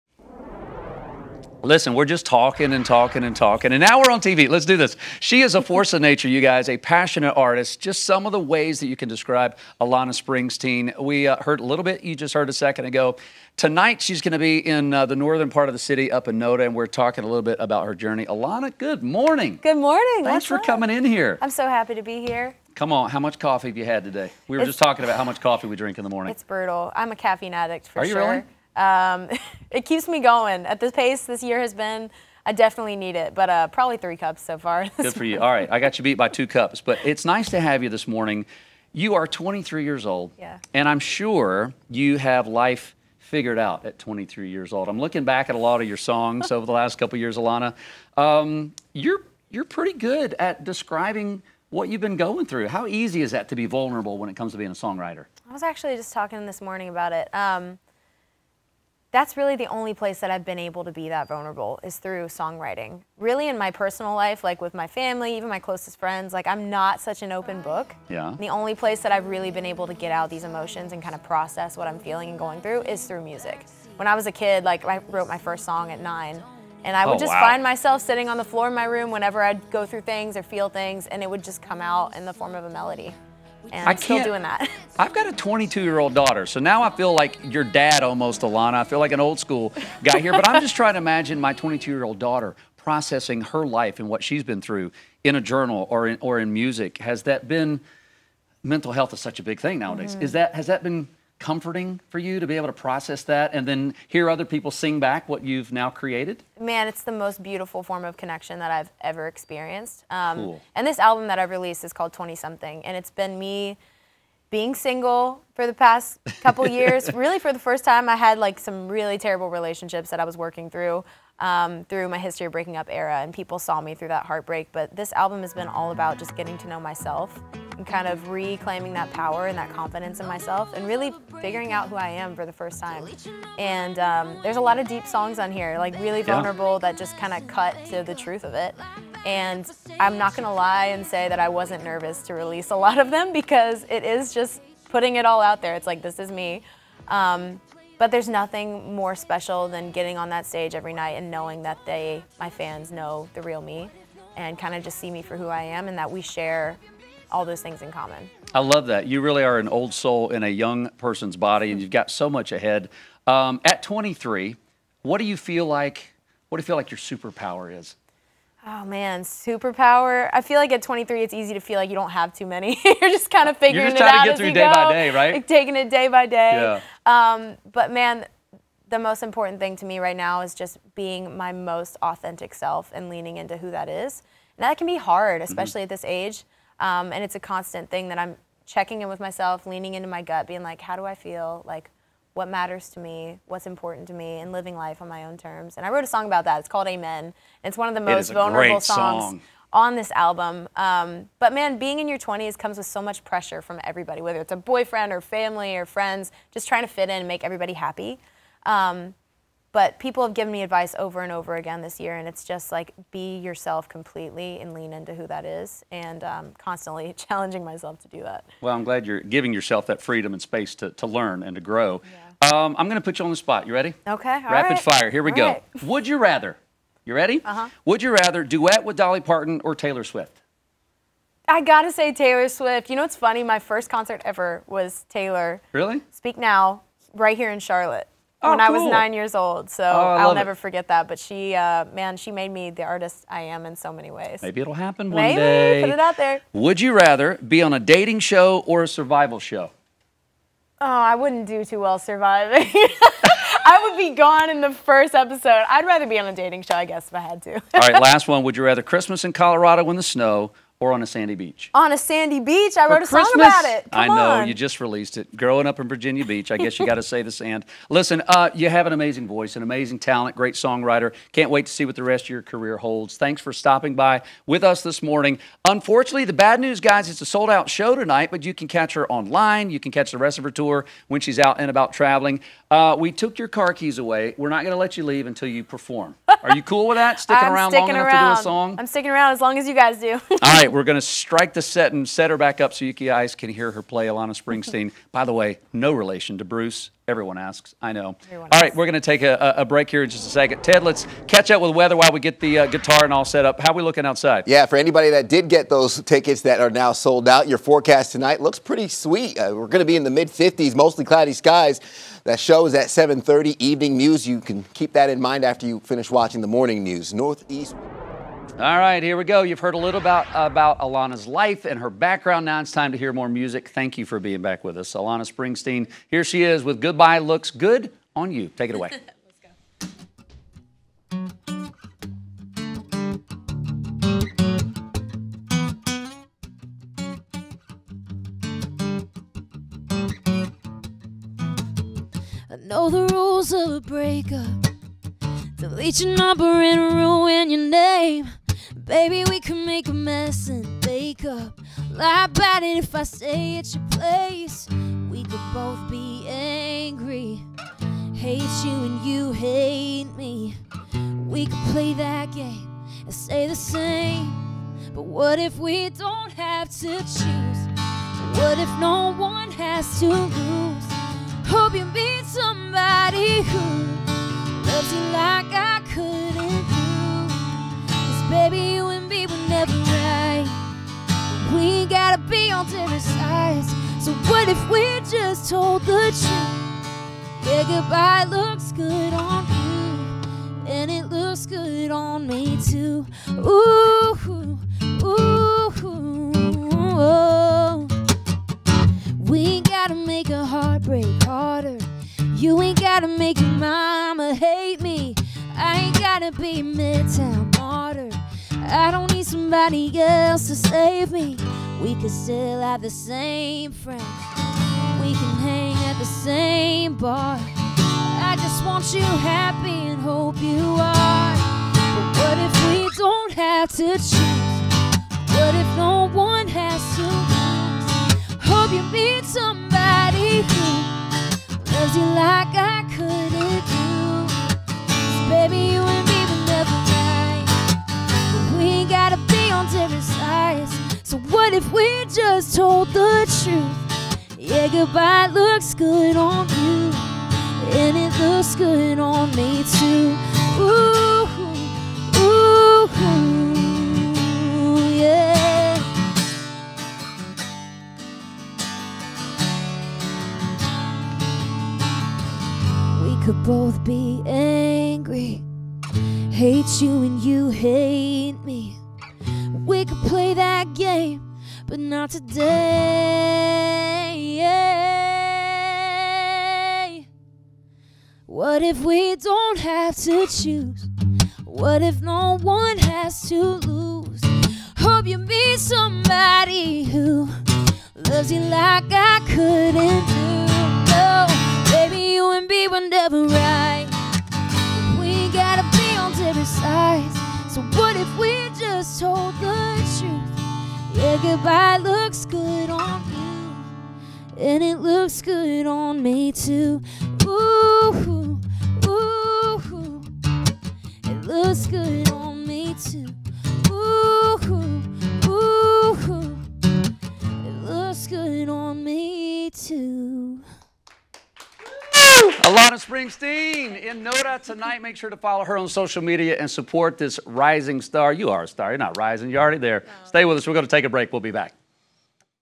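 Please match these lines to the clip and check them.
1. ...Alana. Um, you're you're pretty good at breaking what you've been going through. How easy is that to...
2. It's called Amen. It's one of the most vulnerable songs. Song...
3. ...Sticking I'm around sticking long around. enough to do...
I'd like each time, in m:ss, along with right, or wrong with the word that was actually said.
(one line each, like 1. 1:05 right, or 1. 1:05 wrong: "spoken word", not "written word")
1. 0:47 wrong: "describing", not "breaking"
2. 3:16 right
3. 4:47 right.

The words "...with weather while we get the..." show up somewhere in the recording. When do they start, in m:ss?
5:01.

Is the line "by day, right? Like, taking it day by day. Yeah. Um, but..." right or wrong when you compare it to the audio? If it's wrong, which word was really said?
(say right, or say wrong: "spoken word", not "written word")
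right.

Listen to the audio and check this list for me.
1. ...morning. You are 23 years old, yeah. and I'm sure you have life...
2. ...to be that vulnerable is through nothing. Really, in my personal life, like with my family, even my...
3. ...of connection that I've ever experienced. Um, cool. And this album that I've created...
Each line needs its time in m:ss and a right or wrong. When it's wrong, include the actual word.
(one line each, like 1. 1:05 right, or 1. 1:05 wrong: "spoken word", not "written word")
1. 0:38 right
2. 1:00 wrong: "songwriting", not "nothing"
3. 1:48 wrong: "released", not "created".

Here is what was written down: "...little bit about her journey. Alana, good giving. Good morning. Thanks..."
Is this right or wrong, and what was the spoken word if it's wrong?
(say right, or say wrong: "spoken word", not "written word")
wrong: "morning", not "giving".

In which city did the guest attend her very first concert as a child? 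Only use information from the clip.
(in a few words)
Charlotte.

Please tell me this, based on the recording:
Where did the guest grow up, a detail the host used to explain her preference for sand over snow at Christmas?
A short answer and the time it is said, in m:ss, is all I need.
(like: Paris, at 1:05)
Virginia Beach, at 4:25.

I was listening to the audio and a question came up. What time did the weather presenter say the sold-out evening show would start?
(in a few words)
7:30.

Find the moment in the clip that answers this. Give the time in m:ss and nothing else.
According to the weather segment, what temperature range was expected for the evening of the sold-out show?
5:10.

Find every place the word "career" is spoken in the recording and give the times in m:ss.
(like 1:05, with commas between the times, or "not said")
4:32.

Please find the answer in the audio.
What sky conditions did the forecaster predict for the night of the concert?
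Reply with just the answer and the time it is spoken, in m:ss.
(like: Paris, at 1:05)
Mostly cloudy, at 5:10.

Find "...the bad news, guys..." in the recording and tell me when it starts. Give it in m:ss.
4:36.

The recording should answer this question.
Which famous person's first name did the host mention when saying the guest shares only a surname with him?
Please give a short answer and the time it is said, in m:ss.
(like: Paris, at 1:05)
Bruce, at 4:56.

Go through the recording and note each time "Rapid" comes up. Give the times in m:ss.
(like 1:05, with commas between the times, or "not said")
3:44.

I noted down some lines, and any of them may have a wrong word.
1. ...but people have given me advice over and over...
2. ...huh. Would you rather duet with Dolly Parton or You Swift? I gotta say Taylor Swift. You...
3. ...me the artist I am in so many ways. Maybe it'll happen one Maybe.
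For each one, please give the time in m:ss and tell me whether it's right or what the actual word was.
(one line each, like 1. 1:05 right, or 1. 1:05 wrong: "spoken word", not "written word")
1. 3:29 right
2. 3:47 wrong: "Taylor", not "You"
3. 4:02 right.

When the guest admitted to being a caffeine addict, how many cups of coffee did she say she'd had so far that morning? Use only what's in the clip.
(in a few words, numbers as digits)
3 cups.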